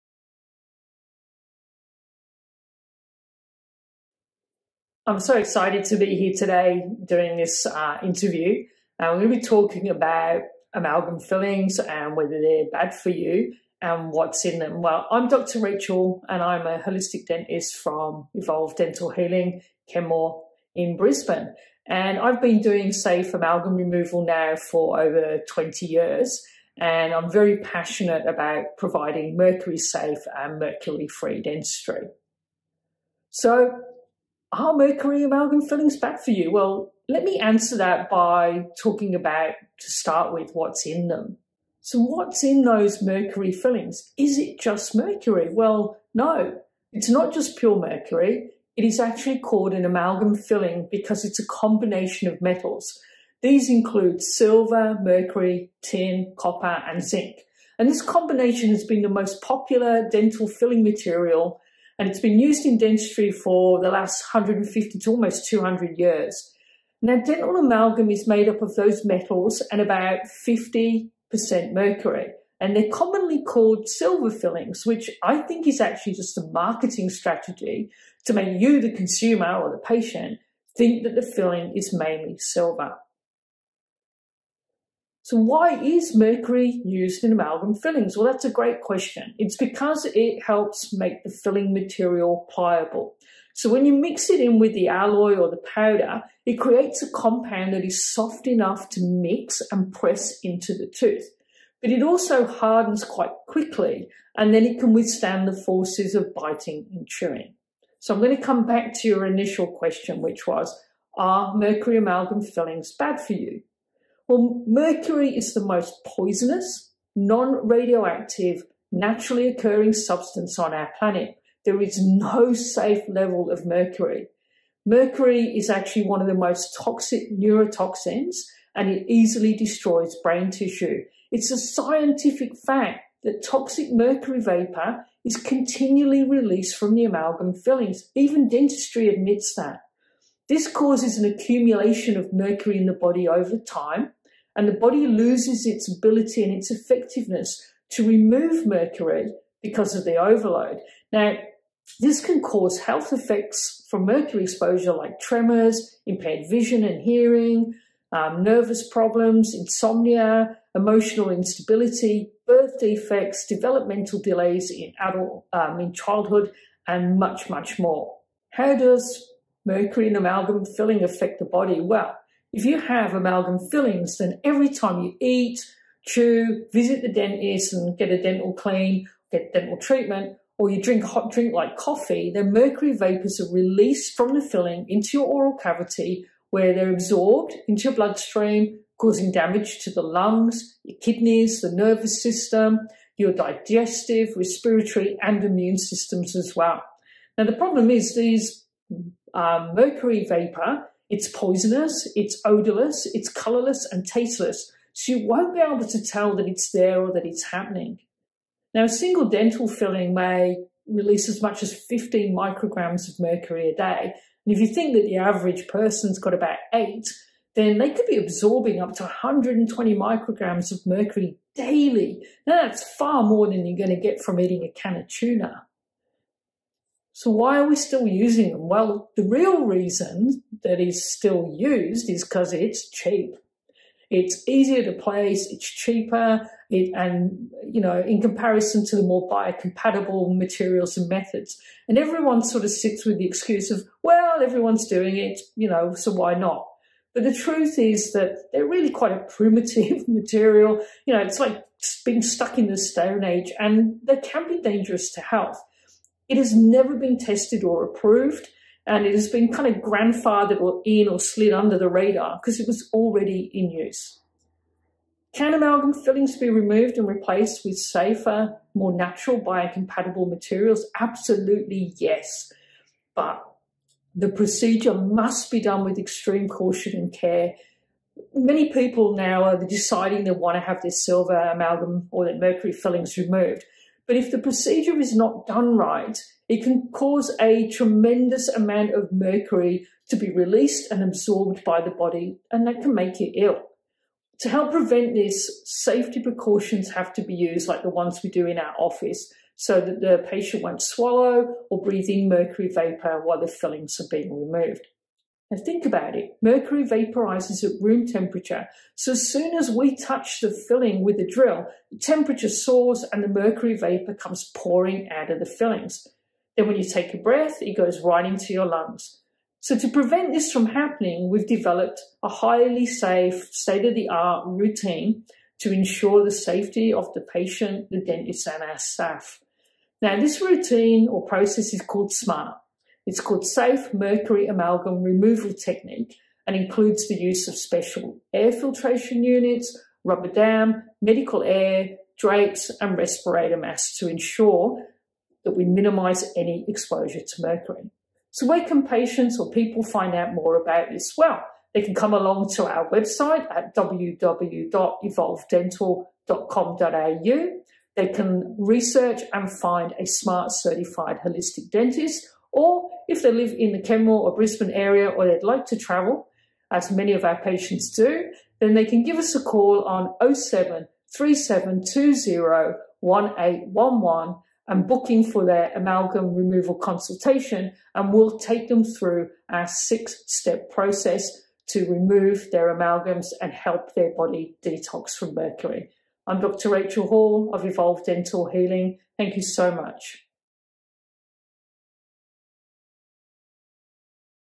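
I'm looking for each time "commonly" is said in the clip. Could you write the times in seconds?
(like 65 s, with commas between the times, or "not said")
72 s.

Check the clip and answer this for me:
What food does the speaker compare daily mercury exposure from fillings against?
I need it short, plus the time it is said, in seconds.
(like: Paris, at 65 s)
a can of tuna, at 224 s.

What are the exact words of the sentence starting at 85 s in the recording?
So why is mercury used in amalgam fillings?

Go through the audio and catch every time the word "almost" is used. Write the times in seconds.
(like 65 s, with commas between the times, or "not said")
65 s.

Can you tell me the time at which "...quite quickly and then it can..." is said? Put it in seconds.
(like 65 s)
103 s.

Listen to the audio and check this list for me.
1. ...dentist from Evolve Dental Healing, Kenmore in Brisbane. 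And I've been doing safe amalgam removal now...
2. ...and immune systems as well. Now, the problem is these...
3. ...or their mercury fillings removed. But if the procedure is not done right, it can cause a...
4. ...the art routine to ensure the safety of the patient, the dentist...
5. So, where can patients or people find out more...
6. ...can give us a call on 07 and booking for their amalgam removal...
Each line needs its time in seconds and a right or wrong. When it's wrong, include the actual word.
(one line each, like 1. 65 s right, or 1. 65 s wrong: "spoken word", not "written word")
1. 17 s right
2. 195 s right
3. 282 s right
4. 323 s right
5. 348 s right
6. 368 s right.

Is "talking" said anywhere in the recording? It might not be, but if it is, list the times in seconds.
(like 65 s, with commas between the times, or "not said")
9 s, 38 s.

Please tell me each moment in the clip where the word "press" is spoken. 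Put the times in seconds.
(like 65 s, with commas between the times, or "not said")
99 s.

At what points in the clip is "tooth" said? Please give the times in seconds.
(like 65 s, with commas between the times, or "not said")
100 s.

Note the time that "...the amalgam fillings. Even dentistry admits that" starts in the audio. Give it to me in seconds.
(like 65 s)
136 s.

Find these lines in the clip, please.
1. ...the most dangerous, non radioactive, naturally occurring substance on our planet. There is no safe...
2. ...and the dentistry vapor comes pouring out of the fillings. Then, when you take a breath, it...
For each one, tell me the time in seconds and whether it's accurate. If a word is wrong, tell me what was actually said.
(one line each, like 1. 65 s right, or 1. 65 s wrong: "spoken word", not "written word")
1. 115 s wrong: "poisonous", not "dangerous"
2. 313 s wrong: "mercury", not "dentistry".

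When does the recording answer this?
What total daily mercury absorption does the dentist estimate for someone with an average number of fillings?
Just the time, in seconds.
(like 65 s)
219 s.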